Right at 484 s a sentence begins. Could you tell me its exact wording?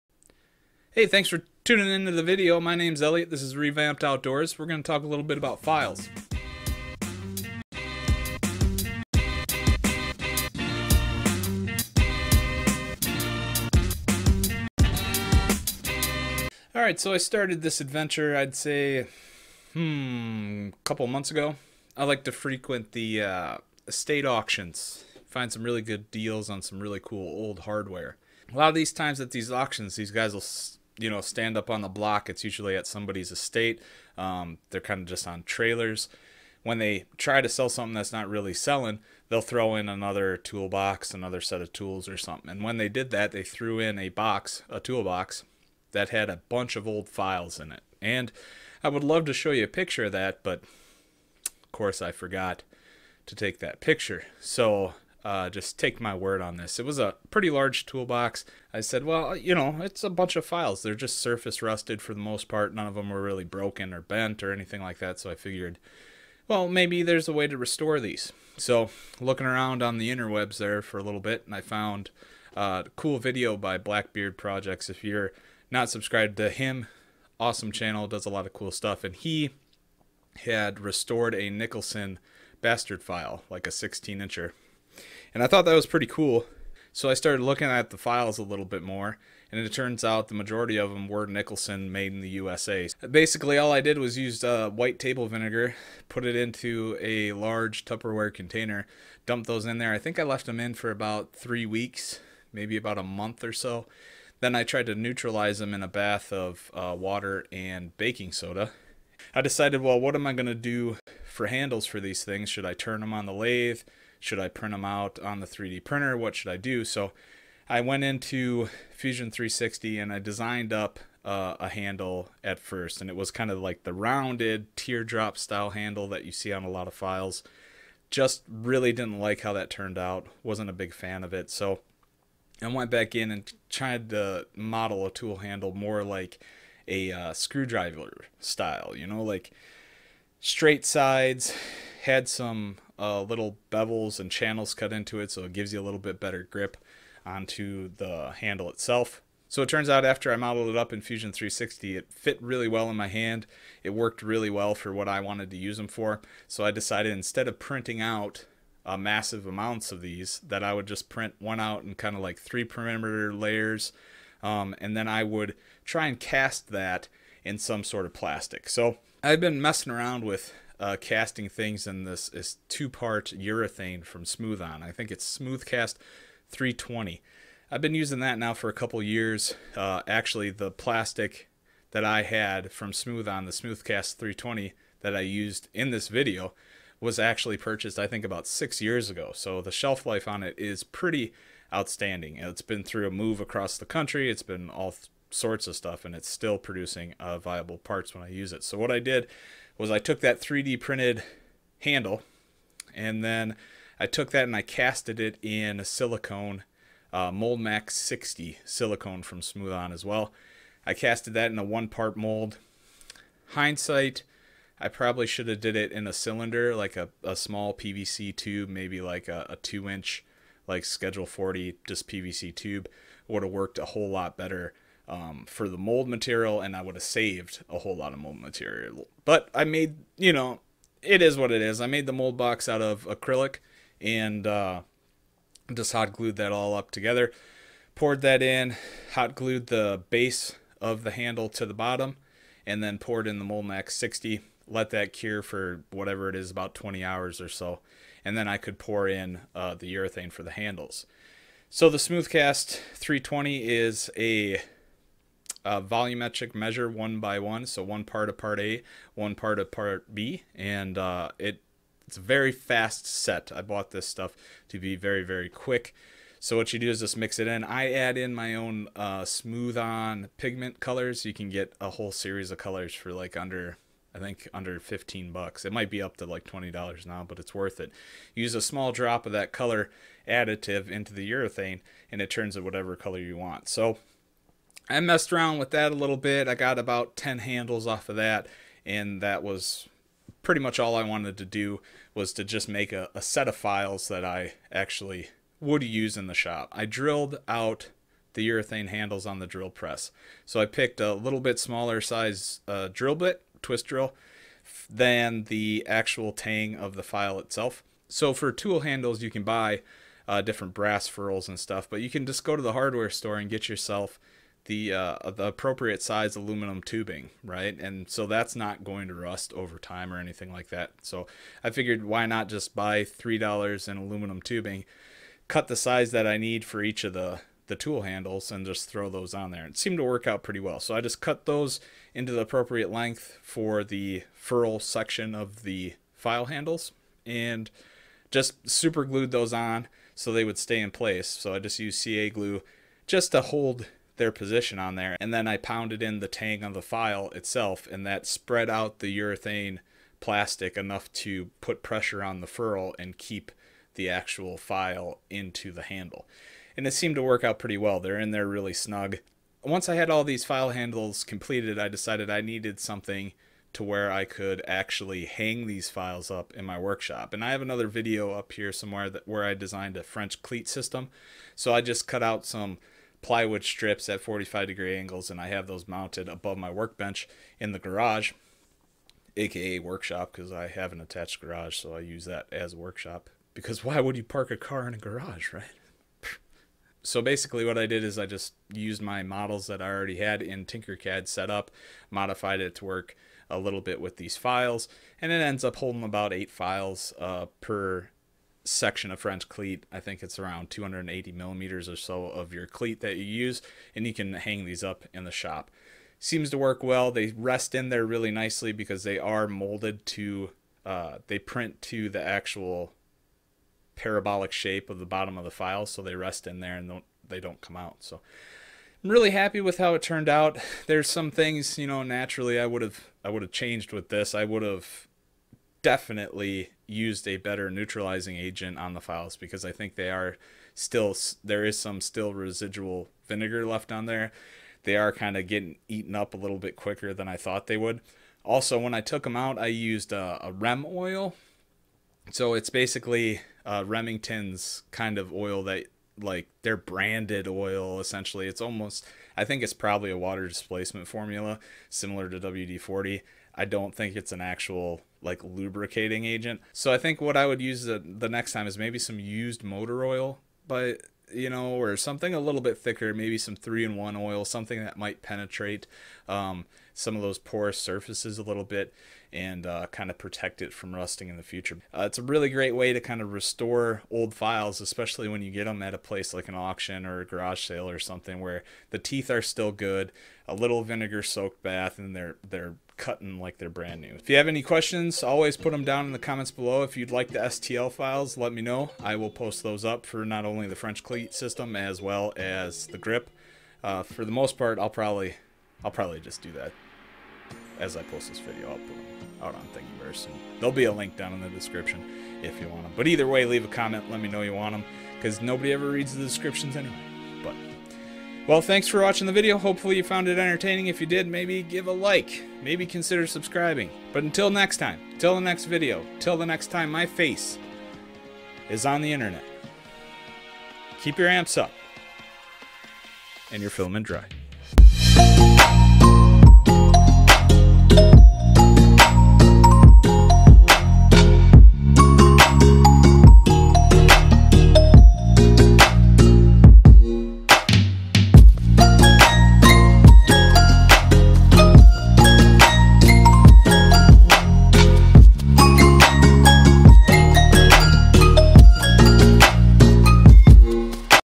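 If you have any questions, always put them down in the comments below.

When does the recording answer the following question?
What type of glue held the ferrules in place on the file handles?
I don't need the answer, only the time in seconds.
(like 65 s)
342 s.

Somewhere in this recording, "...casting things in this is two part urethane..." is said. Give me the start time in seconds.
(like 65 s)
170 s.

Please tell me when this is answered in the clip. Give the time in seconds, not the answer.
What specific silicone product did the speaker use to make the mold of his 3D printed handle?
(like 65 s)
207 s.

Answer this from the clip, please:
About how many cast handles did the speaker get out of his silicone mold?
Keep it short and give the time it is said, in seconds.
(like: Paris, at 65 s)
10, at 286 s.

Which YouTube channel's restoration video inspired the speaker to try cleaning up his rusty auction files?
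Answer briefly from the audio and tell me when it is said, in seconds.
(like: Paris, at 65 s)
Blackbeard Projects, at 73 s.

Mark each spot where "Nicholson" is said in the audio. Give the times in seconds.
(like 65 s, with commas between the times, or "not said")
81 s, 91 s.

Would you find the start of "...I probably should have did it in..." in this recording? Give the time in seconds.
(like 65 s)
214 s.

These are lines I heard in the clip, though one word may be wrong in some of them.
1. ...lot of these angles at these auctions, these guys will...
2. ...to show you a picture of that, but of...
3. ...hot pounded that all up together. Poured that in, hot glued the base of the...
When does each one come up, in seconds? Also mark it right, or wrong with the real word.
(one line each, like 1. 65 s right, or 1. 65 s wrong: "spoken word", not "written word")
1. 28 s wrong: "times", not "angles"
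2. 49 s right
3. 235 s wrong: "glued", not "pounded".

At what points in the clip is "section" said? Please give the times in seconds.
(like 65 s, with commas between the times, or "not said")
334 s, 398 s.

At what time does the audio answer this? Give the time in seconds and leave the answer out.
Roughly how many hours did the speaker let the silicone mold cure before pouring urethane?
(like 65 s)
246 s.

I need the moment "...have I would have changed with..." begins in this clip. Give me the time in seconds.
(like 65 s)
422 s.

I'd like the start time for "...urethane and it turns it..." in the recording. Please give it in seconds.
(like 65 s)
281 s.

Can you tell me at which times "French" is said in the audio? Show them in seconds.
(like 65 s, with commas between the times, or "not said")
370 s, 399 s, 490 s.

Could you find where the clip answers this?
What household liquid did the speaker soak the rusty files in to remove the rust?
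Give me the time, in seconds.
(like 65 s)
94 s.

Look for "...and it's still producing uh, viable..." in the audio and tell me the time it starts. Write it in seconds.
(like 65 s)
196 s.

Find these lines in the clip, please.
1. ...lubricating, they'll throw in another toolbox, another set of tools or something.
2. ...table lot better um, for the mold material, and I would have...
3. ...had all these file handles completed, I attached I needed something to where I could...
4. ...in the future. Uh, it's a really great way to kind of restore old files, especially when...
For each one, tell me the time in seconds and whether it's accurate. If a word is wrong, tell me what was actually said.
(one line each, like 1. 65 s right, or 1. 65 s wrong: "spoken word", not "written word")
1. 38 s wrong: "selling", not "lubricating"
2. 223 s wrong: "whole", not "table"
3. 359 s wrong: "decided", not "attached"
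4. 471 s right.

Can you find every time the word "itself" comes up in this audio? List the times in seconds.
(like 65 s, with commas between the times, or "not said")
148 s, 307 s, 347 s.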